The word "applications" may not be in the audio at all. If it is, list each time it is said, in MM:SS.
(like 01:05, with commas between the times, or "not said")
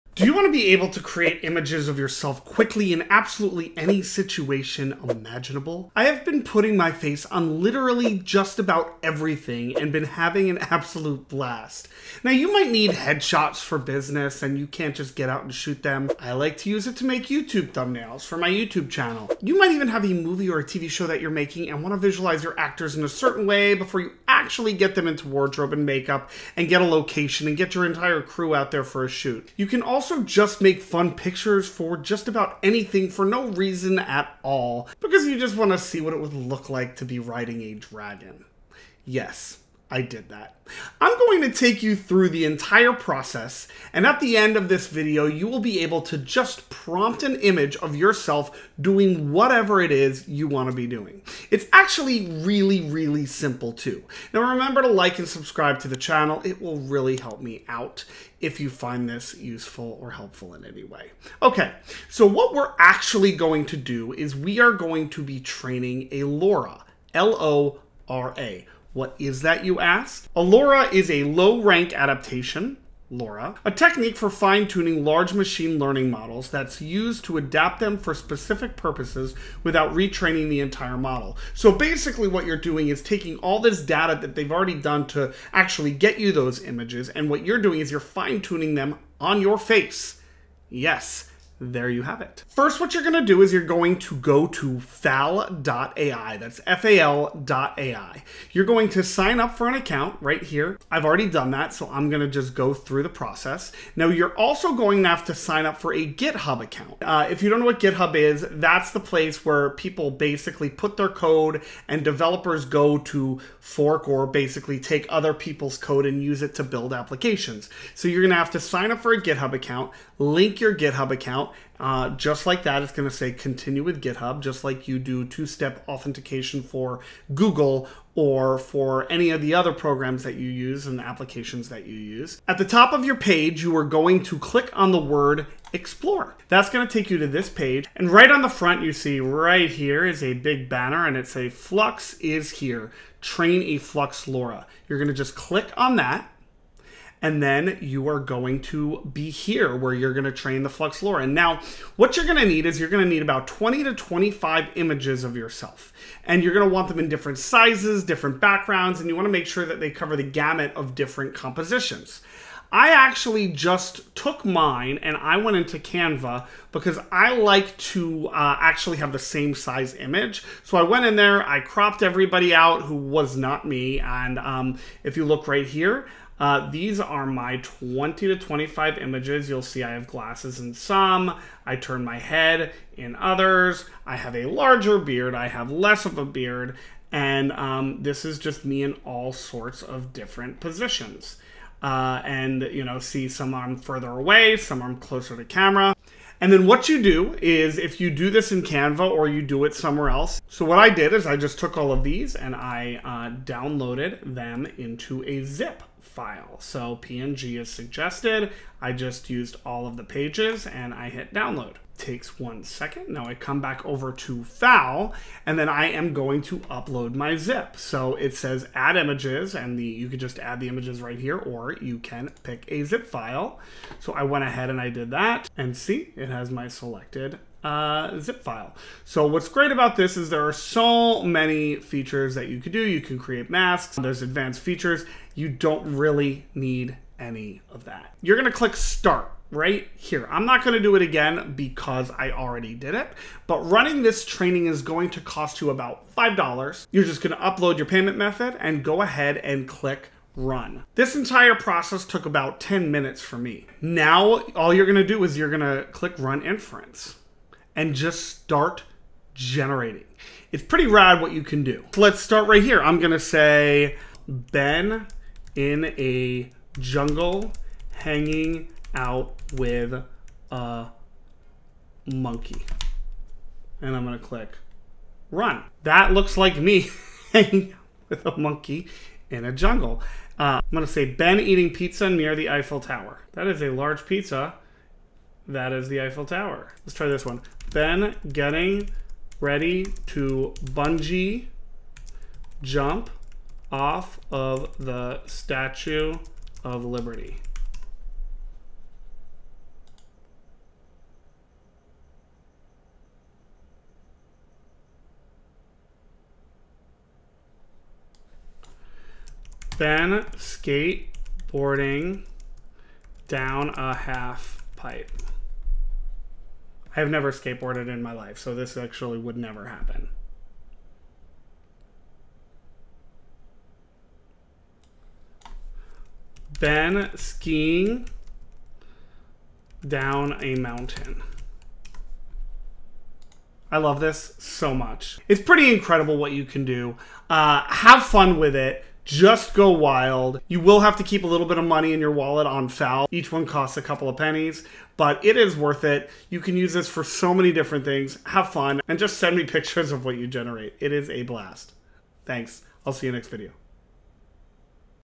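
01:56, 02:10.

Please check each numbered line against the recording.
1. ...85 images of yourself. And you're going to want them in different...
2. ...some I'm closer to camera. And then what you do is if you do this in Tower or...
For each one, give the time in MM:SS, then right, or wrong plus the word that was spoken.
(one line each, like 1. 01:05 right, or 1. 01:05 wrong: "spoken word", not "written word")
1. 02:33 wrong: "25", not "85"
2. 03:14 wrong: "Canva", not "Tower".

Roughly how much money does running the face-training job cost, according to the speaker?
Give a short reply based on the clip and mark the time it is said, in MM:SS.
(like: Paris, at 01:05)
$5, at 04:06.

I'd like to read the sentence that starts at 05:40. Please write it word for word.
You will have to keep a little bit of money in your wallet on fal.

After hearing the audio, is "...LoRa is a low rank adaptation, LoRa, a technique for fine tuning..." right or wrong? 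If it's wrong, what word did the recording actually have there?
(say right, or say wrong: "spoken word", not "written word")
right.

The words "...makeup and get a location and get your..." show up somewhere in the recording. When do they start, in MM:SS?
00:25.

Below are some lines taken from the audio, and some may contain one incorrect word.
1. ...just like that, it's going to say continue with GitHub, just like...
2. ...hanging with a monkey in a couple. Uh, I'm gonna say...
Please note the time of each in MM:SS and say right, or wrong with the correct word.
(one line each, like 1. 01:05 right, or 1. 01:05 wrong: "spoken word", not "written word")
1. 02:02 right
2. 04:37 wrong: "jungle", not "couple".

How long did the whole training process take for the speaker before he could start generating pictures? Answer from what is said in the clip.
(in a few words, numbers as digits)
10 minutes.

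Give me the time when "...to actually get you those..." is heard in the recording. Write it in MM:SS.
01:25.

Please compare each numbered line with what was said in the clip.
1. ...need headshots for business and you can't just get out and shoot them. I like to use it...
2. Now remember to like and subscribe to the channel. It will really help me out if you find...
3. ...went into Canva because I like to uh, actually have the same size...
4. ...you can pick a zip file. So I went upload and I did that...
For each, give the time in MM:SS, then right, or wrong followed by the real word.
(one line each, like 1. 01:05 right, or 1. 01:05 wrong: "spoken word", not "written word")
1. 00:12 right
2. 00:54 right
3. 02:45 right
4. 03:41 wrong: "ahead", not "upload".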